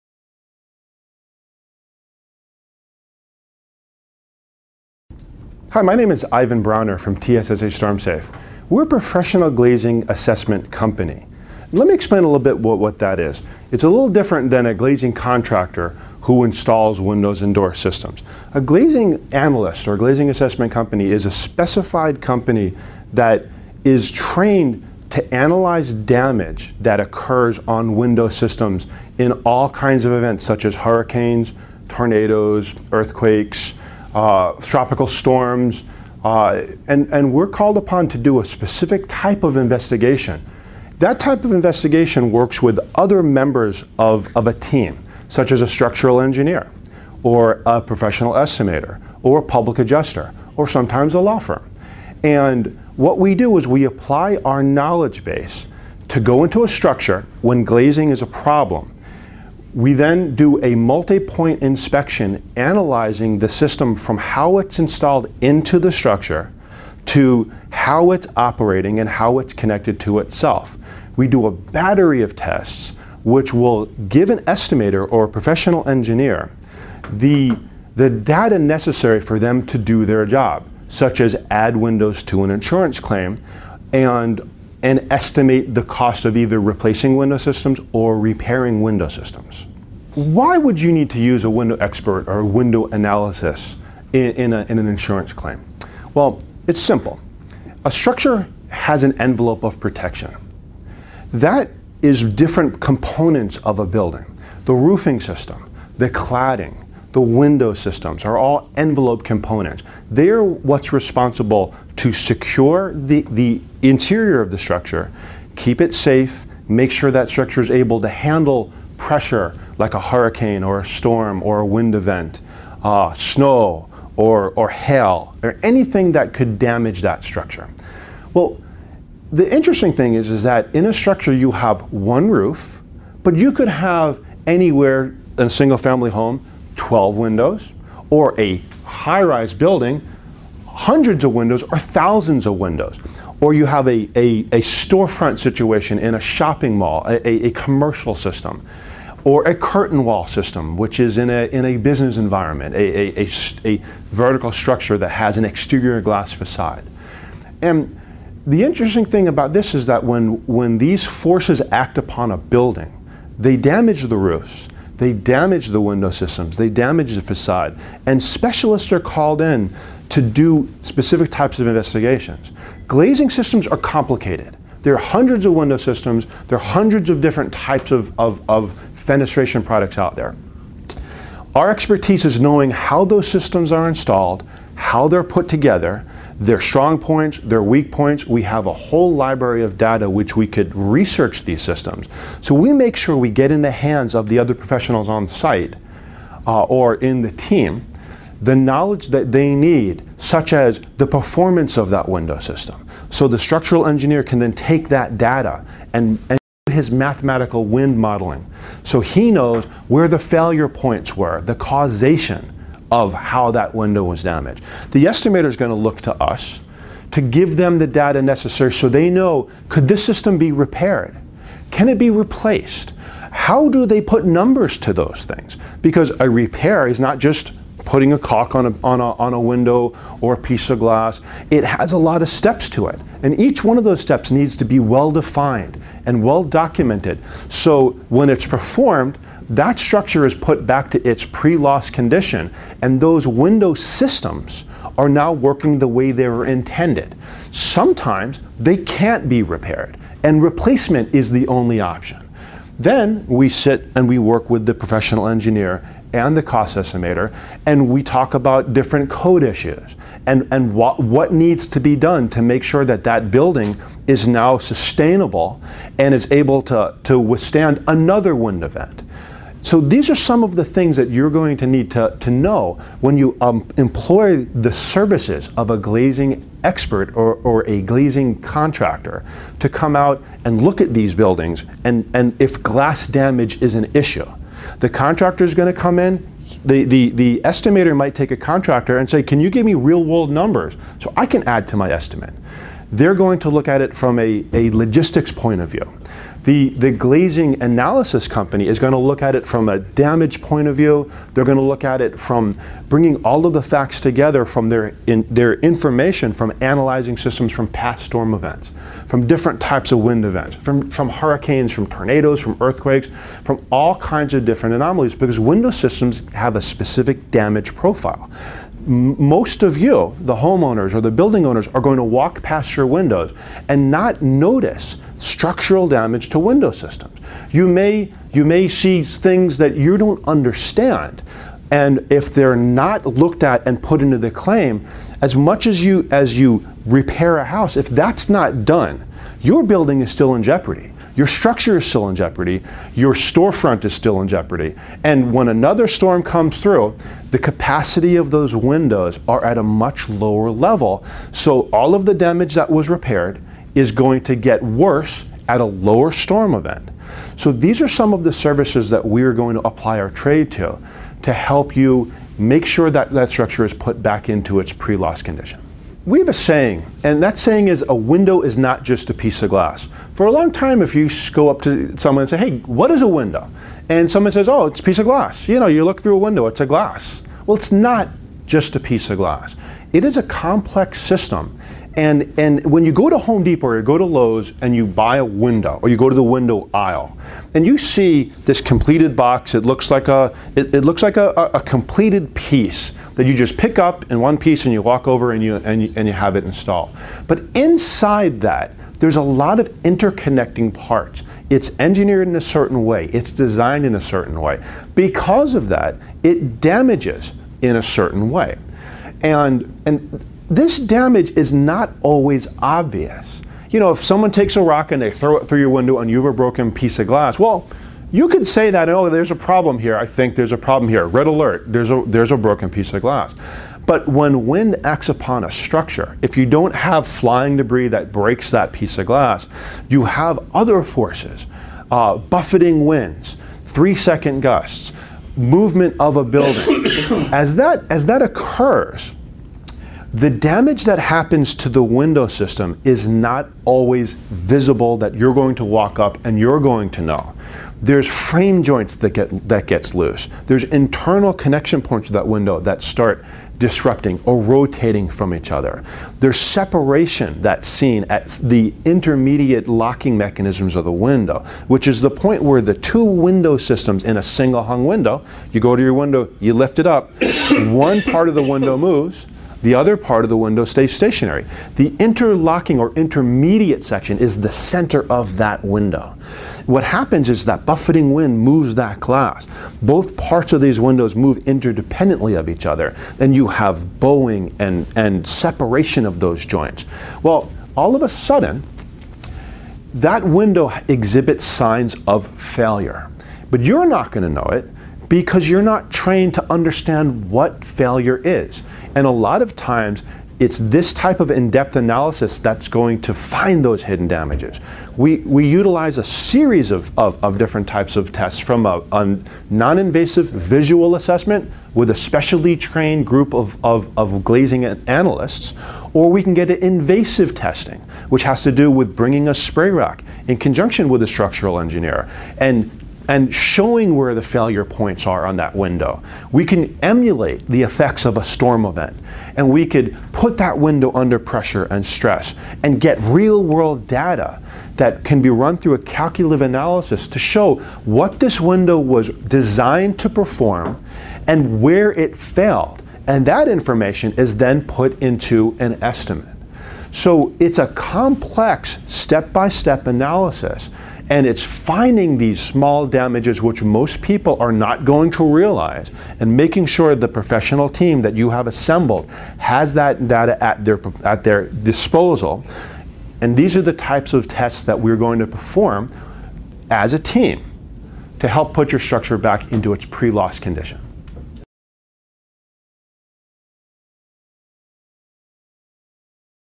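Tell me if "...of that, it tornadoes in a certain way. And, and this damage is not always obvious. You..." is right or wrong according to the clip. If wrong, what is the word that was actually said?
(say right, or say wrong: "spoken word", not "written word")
wrong: "damages", not "tornadoes".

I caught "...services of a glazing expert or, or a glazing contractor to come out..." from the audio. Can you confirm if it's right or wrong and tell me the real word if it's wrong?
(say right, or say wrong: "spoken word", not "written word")
right.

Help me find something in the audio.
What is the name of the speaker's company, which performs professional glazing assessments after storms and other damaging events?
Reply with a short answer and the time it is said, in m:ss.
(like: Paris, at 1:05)
TSSA StormSafe, at 0:07.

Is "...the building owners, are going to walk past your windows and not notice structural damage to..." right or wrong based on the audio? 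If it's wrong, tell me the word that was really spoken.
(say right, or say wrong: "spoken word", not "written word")
right.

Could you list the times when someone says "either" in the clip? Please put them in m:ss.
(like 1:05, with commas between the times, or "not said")
1:26.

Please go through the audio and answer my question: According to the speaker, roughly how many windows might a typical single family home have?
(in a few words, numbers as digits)
12.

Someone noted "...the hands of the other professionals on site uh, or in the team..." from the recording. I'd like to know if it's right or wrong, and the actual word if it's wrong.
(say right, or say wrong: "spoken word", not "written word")
right.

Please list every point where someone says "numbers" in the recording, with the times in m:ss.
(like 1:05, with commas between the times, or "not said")
3:44, 4:50.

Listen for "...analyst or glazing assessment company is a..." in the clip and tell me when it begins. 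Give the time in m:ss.
0:19.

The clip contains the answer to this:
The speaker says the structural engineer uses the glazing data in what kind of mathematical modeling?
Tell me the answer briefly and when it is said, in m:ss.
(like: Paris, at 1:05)
wind modeling, at 3:27.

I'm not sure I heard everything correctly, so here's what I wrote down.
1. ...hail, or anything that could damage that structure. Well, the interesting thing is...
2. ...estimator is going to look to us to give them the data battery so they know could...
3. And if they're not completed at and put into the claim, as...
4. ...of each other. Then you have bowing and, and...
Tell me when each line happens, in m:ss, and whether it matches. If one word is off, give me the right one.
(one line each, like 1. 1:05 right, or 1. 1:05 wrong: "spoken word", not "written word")
1. 2:04 right
2. 3:35 wrong: "necessary", not "battery"
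3. 5:31 wrong: "looked", not "completed"
4. 8:02 right.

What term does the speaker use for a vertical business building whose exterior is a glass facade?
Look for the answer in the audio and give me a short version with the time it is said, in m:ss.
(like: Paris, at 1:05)
curtain wall system, at 2:29.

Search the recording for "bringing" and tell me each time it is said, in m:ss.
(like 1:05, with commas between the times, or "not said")
5:02, 8:38.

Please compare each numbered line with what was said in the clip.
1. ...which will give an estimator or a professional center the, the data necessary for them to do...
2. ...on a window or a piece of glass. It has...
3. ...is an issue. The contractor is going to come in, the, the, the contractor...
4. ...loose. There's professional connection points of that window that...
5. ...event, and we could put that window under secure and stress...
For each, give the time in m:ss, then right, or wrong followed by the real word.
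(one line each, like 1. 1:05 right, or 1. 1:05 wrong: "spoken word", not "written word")
1. 1:13 wrong: "engineer", not "center"
2. 3:49 right
3. 4:43 wrong: "estimator", not "contractor"
4. 7:29 wrong: "internal", not "professional"
5. 8:48 wrong: "pressure", not "secure".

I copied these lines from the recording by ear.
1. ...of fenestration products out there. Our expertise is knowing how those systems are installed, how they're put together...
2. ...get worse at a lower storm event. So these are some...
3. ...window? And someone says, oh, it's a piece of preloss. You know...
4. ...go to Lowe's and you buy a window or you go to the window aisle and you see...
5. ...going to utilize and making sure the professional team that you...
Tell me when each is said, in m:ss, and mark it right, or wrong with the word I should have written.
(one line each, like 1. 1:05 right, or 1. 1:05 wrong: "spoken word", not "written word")
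1. 2:58 right
2. 5:54 right
3. 6:13 wrong: "glass", not "preloss"
4. 6:23 right
5. 9:14 wrong: "realize", not "utilize".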